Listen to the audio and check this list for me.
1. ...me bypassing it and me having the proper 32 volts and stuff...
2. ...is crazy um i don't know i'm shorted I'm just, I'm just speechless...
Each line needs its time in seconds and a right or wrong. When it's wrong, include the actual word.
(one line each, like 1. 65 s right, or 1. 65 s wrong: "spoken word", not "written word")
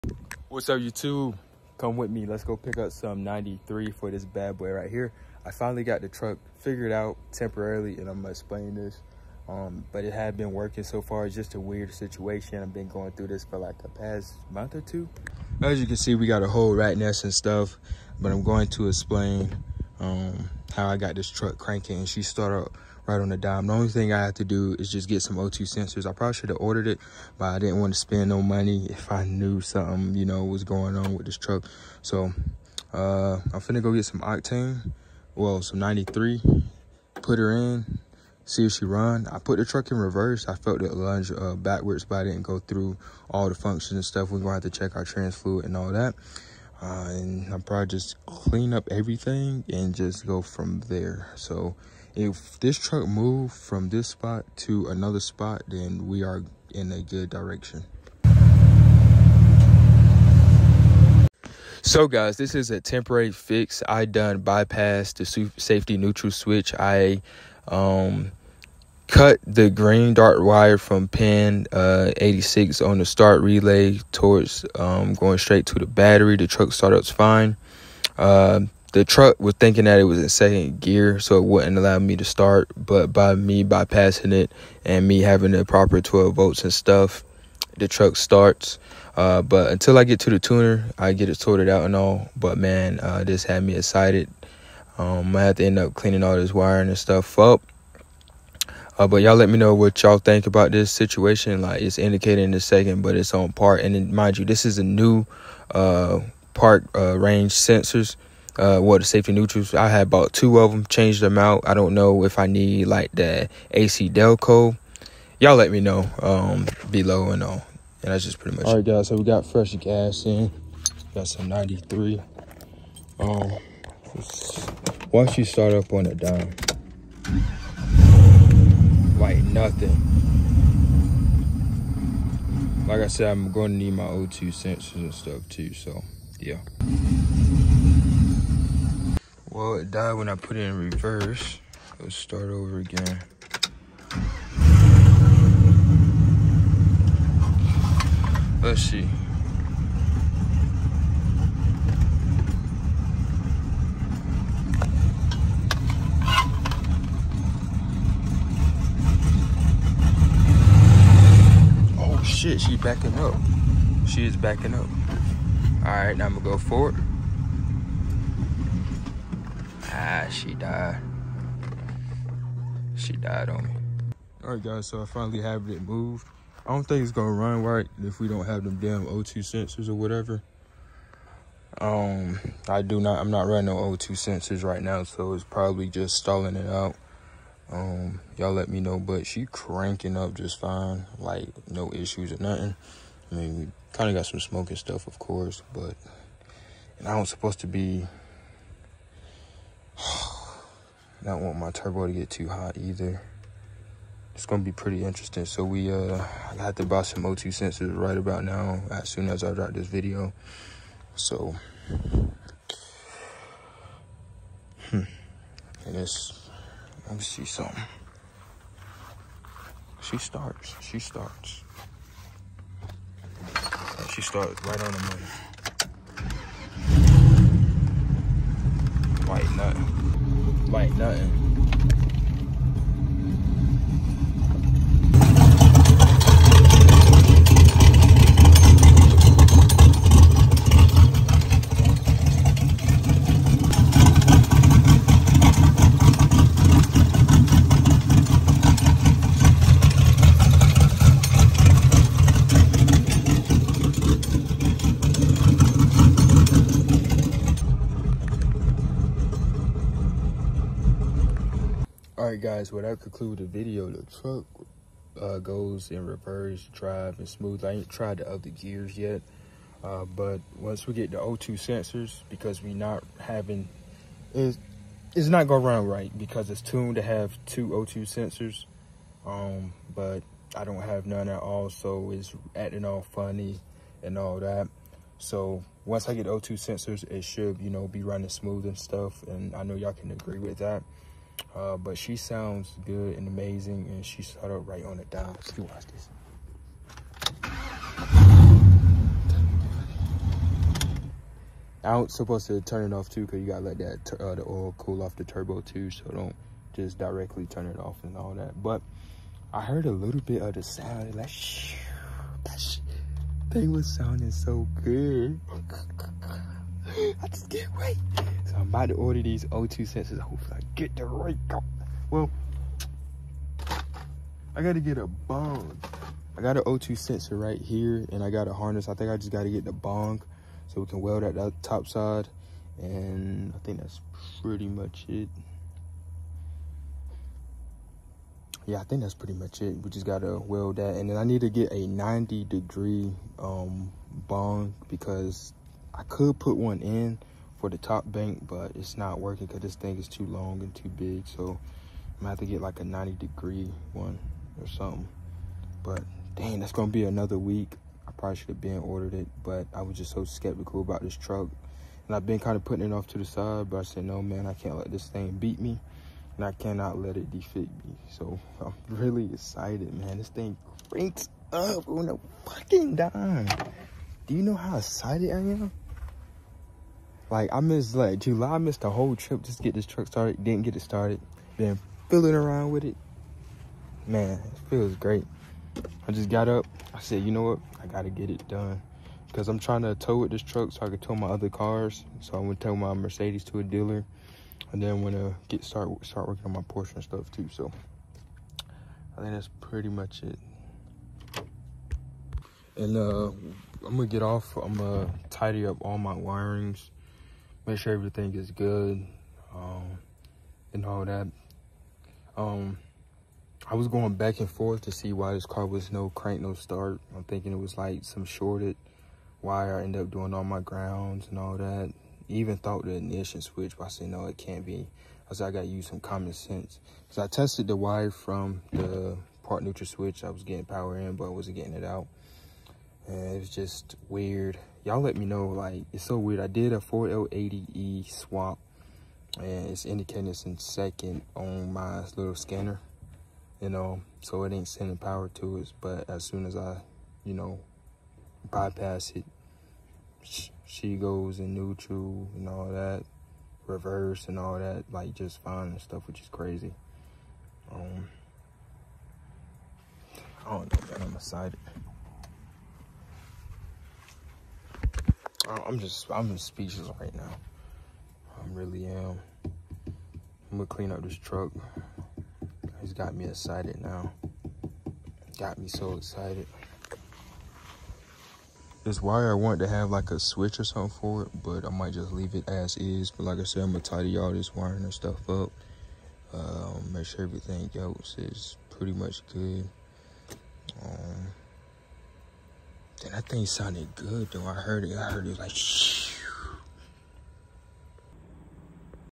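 1. 83 s wrong: "12", not "32"
2. 456 s wrong: "excited", not "shorted".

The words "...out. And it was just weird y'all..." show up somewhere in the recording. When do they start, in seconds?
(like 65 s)
431 s.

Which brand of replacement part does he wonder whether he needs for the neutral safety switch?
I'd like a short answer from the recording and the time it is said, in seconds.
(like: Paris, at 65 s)
AC Delco, at 113 s.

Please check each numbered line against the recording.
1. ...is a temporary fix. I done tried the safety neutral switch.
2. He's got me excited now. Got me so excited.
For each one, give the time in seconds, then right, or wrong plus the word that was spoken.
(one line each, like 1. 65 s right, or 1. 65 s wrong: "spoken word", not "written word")
1. 62 s wrong: "bypassed", not "tried"
2. 472 s right.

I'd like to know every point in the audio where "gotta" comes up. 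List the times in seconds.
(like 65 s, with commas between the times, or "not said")
303 s, 324 s, 329 s, 340 s, 387 s.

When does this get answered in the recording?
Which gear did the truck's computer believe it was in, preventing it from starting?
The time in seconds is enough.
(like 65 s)
80 s.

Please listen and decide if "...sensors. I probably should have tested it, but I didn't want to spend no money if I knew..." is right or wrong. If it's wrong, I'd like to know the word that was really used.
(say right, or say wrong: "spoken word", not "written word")
wrong: "ordered", not "tested".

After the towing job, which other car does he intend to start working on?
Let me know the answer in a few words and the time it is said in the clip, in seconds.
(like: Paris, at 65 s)
Porsche, at 396 s.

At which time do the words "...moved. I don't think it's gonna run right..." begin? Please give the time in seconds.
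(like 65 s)
175 s.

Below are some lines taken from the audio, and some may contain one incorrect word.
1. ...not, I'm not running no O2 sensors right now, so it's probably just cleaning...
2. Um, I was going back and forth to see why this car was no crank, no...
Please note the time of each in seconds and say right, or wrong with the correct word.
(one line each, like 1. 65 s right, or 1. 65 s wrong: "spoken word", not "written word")
1. 182 s wrong: "stalling", not "cleaning"
2. 412 s right.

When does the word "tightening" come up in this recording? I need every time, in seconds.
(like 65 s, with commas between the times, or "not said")
not said.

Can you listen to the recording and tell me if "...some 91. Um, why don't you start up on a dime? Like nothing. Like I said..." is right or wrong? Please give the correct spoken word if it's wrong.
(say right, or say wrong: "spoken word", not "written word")
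wrong: "93", not "91".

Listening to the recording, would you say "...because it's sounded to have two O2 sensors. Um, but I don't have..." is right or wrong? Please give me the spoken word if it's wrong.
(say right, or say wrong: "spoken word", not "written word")
wrong: "tuned", not "sounded".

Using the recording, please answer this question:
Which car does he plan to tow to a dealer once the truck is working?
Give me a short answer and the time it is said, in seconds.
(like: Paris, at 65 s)
Mercedes, at 392 s.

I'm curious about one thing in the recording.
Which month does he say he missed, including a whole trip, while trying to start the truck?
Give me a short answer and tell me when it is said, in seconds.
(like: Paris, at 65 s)
July, at 378 s.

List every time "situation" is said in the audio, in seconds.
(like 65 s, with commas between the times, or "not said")
11 s, 100 s.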